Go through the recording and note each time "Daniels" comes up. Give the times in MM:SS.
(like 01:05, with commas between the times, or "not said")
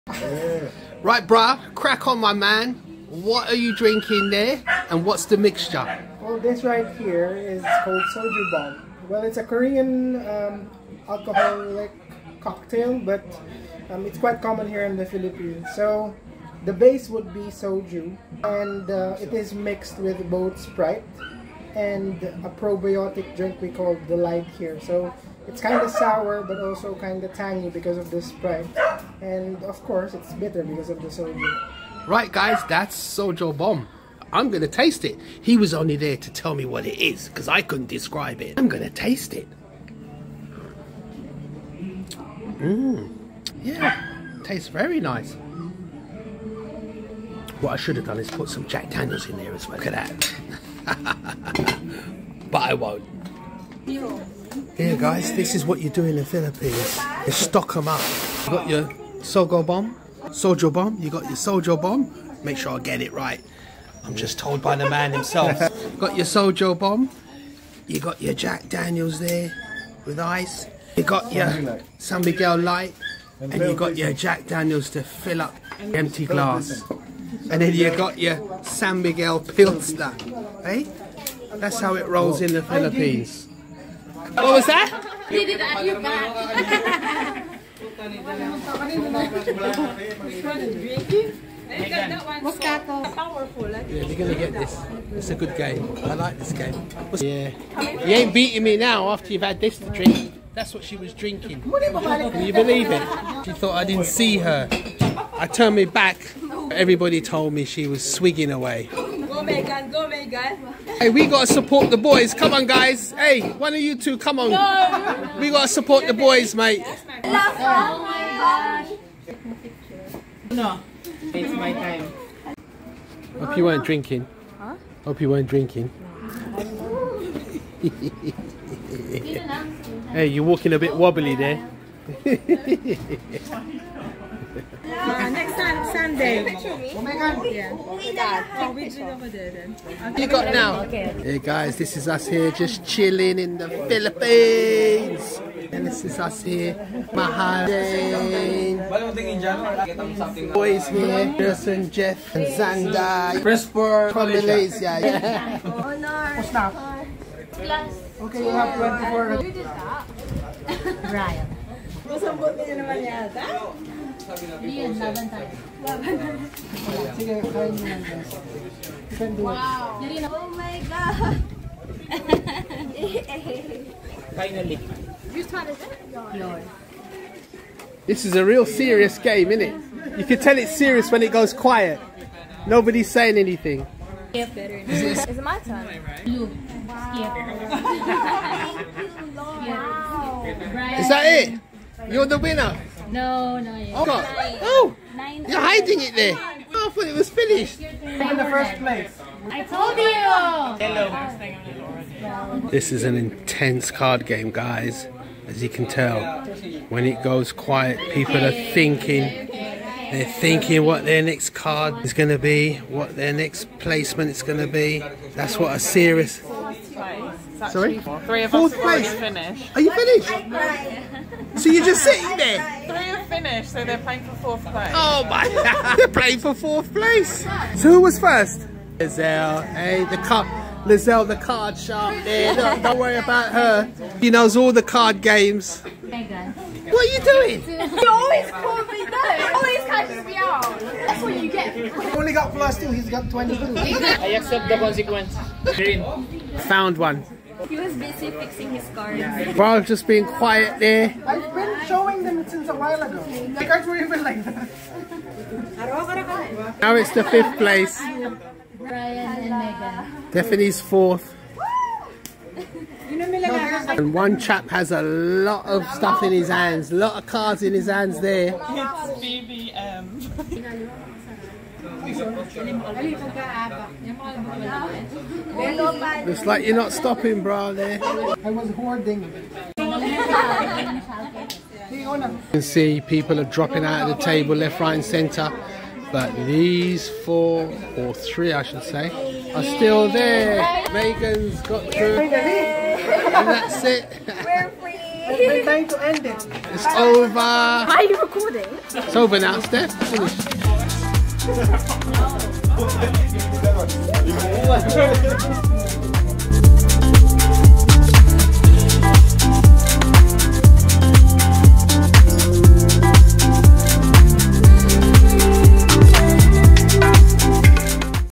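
00:48, 01:08, 01:14.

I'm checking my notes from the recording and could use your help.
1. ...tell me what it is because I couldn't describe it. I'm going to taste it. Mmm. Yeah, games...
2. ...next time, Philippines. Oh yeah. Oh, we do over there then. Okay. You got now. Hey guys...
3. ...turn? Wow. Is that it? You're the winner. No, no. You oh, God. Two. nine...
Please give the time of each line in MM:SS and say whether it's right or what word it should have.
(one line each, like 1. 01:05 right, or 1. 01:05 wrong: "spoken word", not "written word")
1. 00:36 wrong: "tastes", not "games"
2. 02:15 wrong: "Sunday", not "Philippines"
3. 03:05 wrong: "Nine", not "Two".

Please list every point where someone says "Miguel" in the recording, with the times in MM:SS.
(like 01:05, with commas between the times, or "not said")
01:12, 01:19.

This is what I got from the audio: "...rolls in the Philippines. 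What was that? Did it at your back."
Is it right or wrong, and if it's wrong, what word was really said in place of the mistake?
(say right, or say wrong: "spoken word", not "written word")
right.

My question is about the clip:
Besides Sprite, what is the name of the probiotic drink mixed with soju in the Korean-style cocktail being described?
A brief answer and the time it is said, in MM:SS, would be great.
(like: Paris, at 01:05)
Delight, at 00:24.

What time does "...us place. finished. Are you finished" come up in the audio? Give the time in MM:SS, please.
03:38.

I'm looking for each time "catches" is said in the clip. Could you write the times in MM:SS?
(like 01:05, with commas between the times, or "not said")
03:59.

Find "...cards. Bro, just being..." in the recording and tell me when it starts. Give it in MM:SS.
04:08.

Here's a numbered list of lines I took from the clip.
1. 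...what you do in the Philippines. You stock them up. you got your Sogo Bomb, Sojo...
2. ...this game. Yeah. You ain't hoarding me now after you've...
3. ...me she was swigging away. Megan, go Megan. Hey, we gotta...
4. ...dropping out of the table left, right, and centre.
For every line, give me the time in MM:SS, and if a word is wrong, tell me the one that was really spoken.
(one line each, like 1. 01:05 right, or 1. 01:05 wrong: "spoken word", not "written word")
1. 00:55 right
2. 01:36 wrong: "beating", not "hoarding"
3. 01:47 right
4. 04:43 right.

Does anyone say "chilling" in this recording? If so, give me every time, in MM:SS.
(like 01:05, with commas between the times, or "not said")
02:22.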